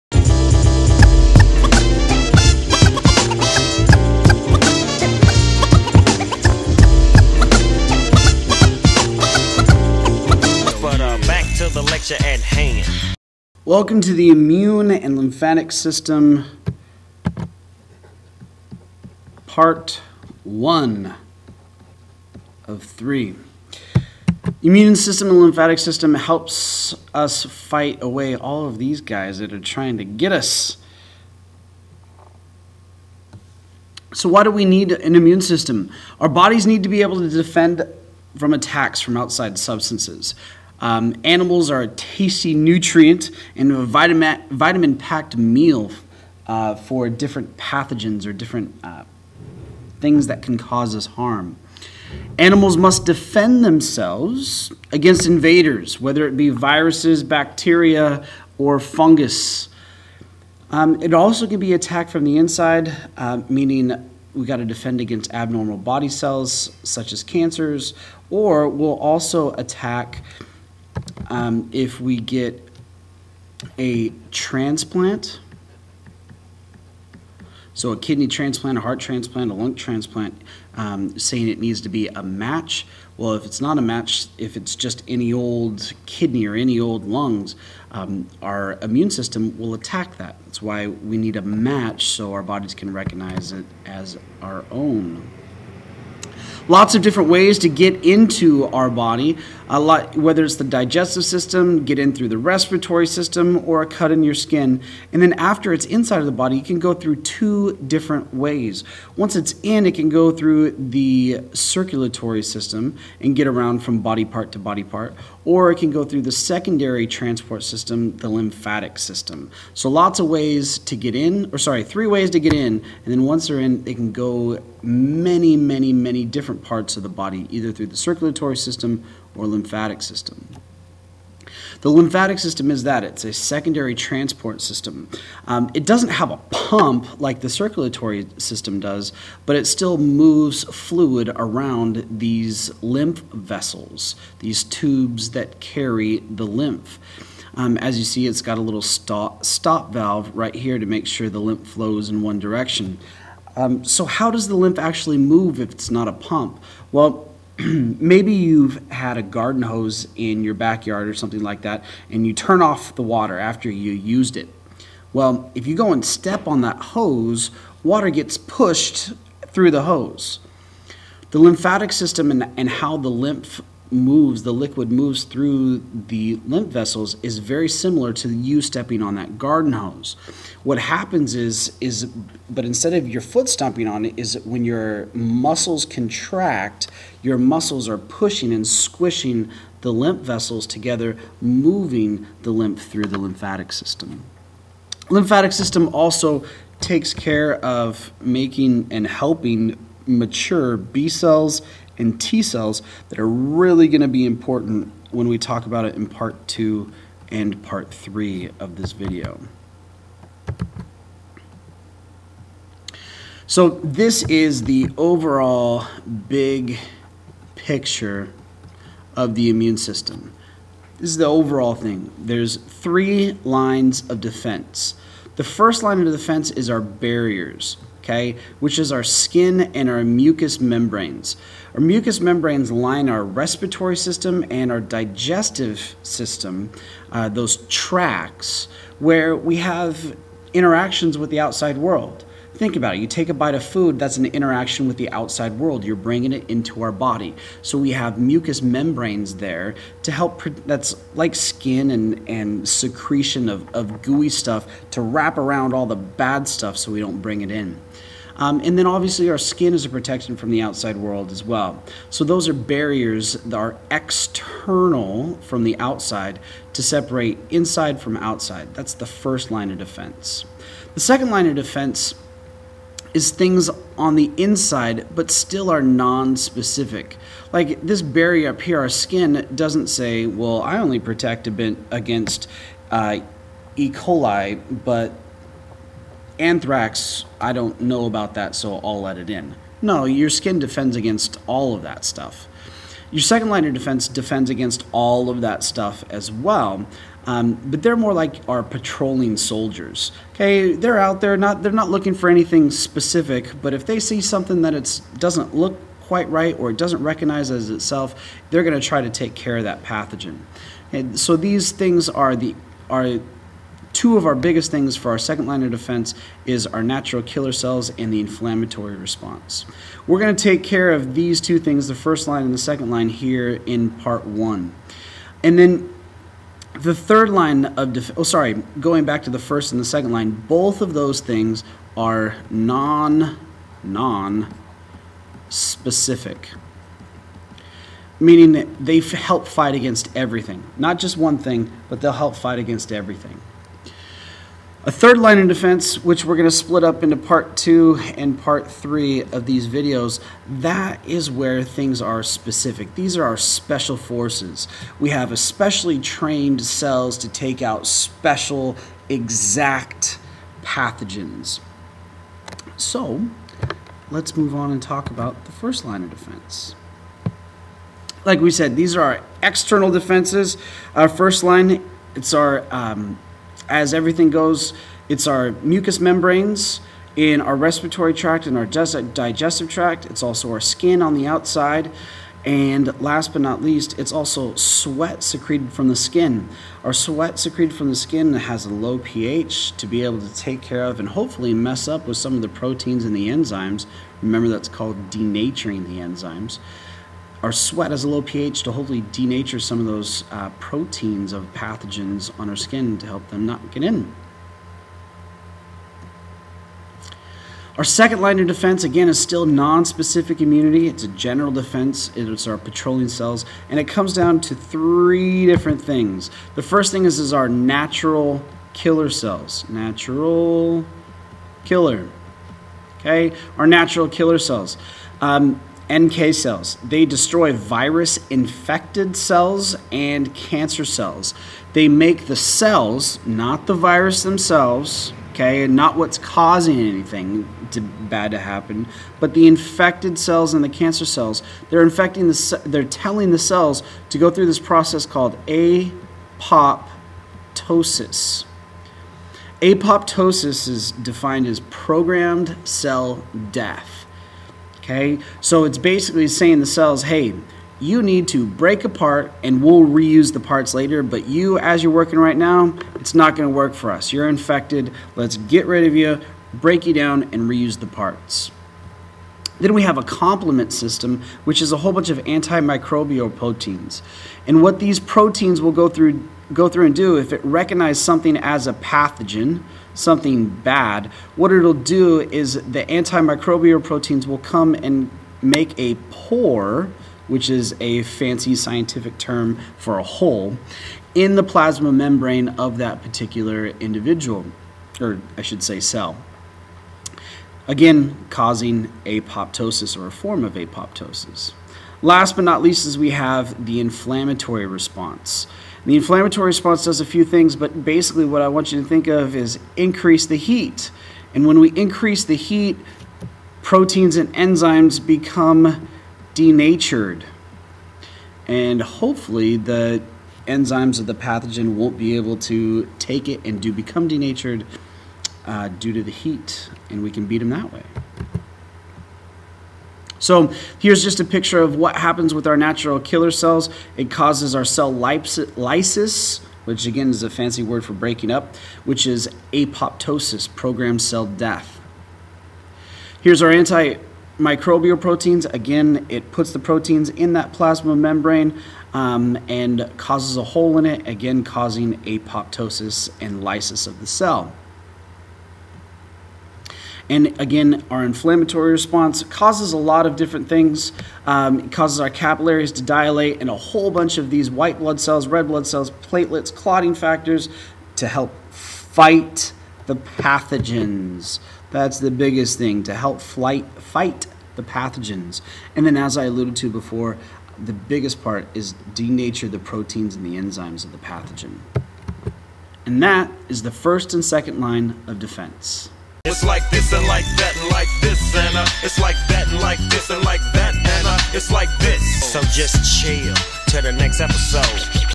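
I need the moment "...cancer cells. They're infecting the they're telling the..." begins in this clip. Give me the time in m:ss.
7:20.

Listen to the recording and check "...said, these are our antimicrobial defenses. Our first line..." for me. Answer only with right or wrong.
wrong.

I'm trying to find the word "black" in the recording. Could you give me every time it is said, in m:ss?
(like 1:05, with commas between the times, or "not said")
not said.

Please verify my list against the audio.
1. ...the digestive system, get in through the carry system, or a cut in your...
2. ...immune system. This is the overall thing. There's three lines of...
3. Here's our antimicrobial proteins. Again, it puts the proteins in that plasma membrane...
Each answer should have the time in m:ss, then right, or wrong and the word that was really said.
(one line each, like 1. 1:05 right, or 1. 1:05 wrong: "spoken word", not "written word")
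1. 1:40 wrong: "respiratory", not "carry"
2. 3:39 right
3. 9:03 right.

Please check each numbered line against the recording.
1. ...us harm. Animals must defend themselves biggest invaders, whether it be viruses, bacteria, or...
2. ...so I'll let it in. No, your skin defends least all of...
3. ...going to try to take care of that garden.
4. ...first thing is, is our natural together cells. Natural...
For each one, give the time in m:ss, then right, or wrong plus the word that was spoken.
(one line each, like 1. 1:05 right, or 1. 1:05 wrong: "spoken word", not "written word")
1. 0:50 wrong: "against", not "biggest"
2. 4:48 wrong: "against", not "least"
3. 5:08 wrong: "pathogen", not "garden"
4. 6:56 wrong: "killer", not "together".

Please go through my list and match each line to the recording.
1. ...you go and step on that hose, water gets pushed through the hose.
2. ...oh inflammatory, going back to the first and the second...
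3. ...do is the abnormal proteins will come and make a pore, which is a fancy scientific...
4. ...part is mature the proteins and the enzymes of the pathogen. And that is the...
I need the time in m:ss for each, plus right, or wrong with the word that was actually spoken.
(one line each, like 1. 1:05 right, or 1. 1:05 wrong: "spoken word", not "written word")
1. 2:45 right
2. 5:28 wrong: "sorry", not "inflammatory"
3. 8:01 wrong: "antimicrobial", not "abnormal"
4. 9:38 wrong: "denature", not "mature".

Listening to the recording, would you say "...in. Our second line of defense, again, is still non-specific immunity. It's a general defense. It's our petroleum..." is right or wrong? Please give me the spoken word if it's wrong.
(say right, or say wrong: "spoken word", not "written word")
right.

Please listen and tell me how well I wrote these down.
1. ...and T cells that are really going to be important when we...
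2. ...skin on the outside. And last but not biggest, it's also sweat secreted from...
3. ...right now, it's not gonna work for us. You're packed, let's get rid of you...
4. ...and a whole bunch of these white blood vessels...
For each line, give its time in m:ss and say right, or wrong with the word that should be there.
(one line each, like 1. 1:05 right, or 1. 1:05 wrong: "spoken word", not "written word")
1. 3:22 right
2. 6:20 wrong: "least", not "biggest"
3. 7:42 wrong: "infected", not "packed"
4. 9:23 wrong: "cells", not "vessels".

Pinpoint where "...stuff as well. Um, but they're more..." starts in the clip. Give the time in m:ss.
4:55.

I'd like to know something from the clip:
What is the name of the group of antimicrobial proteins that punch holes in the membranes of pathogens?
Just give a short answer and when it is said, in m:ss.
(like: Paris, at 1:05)
complement system, at 7:50.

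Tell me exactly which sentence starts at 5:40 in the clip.
Not just one thing, but they'll help fight against everything.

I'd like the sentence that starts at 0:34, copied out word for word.
So why do we need an immune system?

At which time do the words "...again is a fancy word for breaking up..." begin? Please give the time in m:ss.
8:56.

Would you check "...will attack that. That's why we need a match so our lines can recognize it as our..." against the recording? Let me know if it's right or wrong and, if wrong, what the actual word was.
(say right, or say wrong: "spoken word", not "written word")
wrong: "bodies", not "lines".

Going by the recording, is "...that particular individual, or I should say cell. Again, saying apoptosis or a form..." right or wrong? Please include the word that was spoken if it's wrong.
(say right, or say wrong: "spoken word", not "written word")
wrong: "causing", not "saying".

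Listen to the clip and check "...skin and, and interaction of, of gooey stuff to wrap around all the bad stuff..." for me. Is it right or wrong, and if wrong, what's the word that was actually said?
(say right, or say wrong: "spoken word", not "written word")
wrong: "secretion", not "interaction".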